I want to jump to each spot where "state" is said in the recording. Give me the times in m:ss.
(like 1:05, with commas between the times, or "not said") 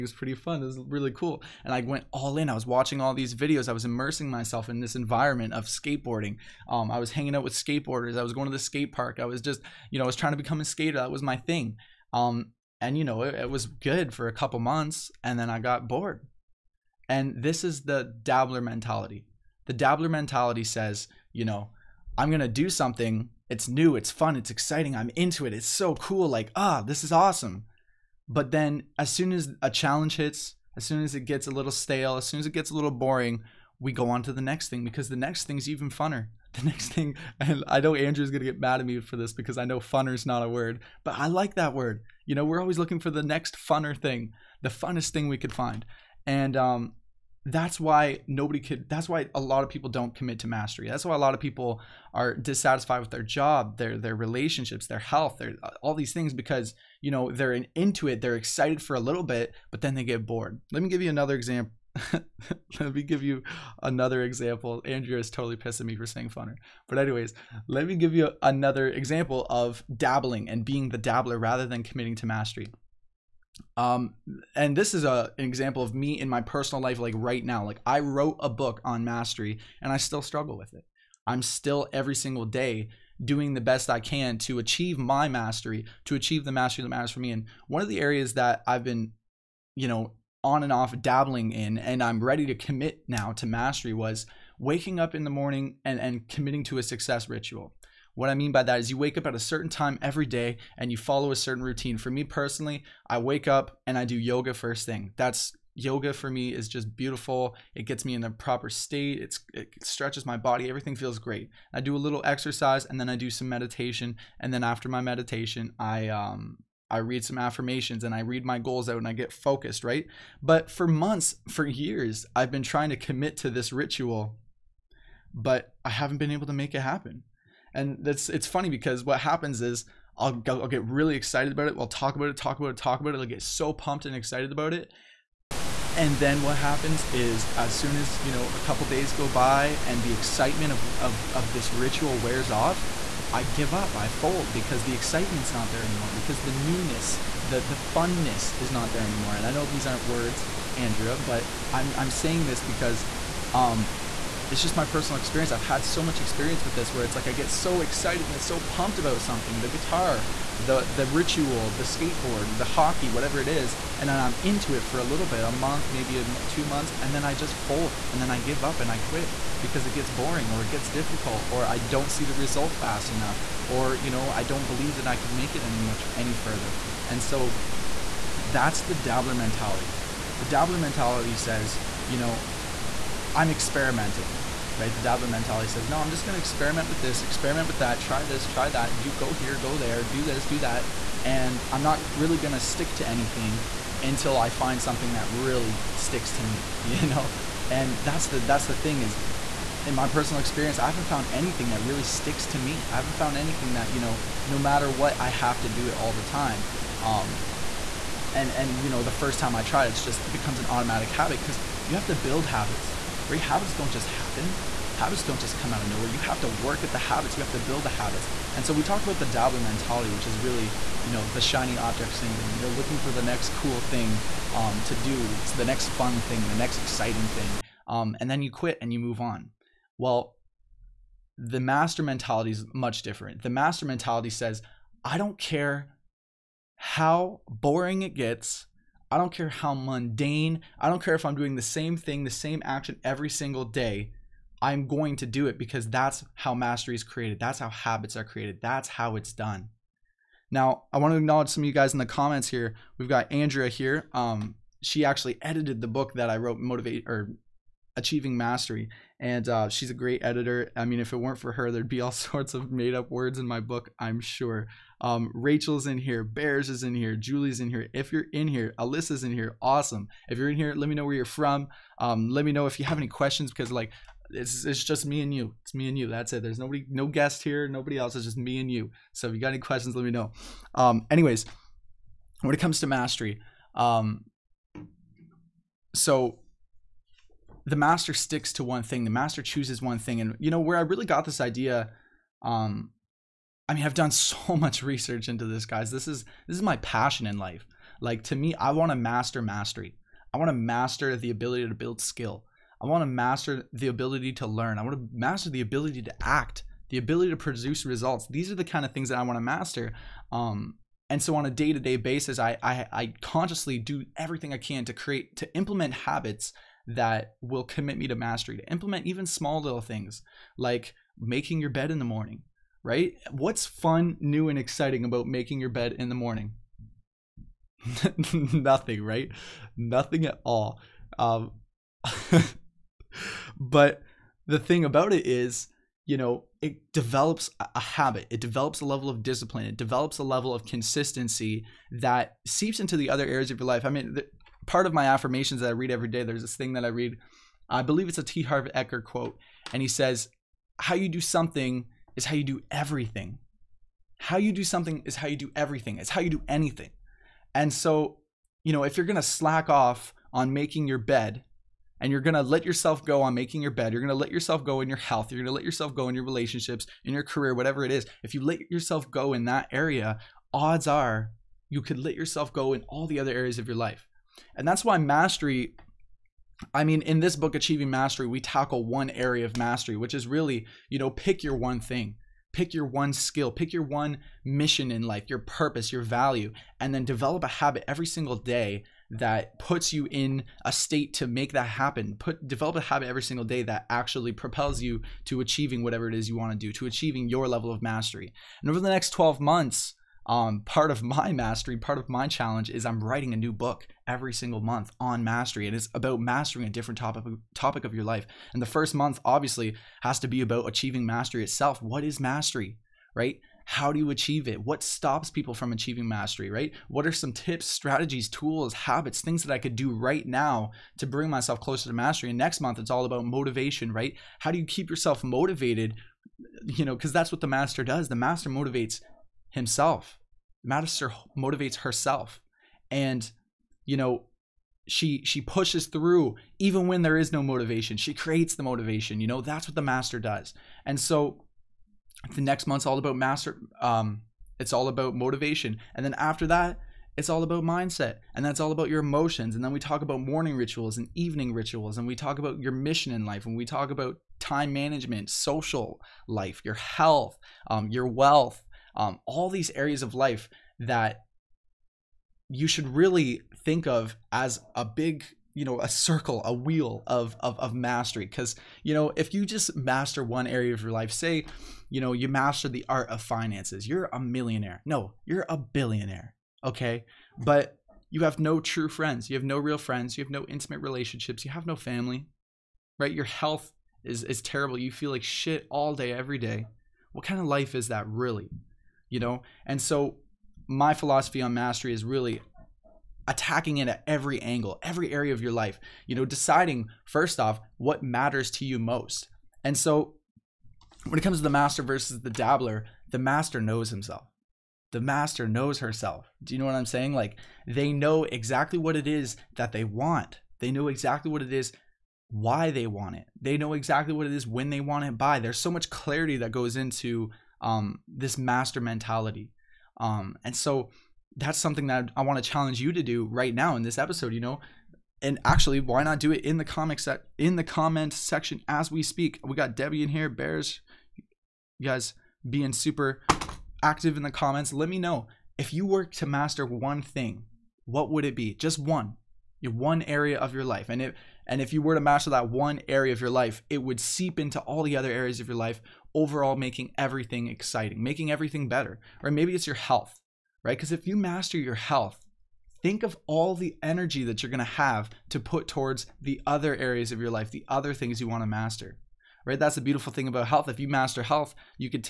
1:48, 6:30.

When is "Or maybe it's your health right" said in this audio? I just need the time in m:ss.
9:09.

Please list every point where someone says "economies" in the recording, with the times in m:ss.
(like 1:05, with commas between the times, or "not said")
not said.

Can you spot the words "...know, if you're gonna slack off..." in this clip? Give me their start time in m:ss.
5:58.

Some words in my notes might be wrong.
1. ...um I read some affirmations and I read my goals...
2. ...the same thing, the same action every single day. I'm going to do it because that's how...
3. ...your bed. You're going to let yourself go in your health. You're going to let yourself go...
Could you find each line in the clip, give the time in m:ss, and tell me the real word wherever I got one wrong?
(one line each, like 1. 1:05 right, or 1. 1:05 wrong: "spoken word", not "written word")
1. 1:56 right
2. 4:01 right
3. 6:03 right.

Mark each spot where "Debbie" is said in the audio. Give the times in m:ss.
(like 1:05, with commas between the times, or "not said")
8:49.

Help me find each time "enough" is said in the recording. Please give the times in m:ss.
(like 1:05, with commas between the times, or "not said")
2:53.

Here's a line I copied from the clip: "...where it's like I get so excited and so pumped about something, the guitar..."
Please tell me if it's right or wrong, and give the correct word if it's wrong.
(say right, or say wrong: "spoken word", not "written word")
right.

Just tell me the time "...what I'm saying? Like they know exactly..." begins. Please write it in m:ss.
8:26.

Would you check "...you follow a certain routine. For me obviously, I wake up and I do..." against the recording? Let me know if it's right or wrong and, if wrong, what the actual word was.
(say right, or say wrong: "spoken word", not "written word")
wrong: "personally", not "obviously".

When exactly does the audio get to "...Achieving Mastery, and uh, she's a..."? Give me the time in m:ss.
4:17.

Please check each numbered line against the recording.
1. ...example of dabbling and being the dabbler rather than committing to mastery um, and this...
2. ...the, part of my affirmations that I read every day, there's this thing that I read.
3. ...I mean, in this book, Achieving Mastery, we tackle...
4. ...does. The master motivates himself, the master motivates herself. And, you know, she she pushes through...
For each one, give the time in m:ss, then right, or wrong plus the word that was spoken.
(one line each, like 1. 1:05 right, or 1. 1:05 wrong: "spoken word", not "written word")
1. 1:08 right
2. 5:44 right
3. 6:16 right
4. 7:07 right.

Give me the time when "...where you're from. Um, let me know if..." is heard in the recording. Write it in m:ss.
4:31.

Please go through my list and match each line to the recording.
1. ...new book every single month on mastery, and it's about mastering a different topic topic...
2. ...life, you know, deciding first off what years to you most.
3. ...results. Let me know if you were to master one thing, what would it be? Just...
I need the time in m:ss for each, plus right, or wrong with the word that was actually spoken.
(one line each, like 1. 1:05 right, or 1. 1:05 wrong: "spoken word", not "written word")
1. 6:43 right
2. 8:15 wrong: "matters", not "years"
3. 8:54 wrong: "comments", not "results".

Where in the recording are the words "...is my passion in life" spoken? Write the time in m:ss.
4:56.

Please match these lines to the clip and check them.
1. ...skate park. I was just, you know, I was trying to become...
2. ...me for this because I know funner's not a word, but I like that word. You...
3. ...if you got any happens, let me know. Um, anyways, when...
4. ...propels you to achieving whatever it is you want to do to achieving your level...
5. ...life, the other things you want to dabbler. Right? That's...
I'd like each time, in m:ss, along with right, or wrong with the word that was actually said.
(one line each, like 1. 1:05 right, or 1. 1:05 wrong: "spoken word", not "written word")
1. 0:08 right
2. 0:38 right
3. 4:39 wrong: "questions", not "happens"
4. 6:34 right
5. 9:17 wrong: "master", not "dabbler".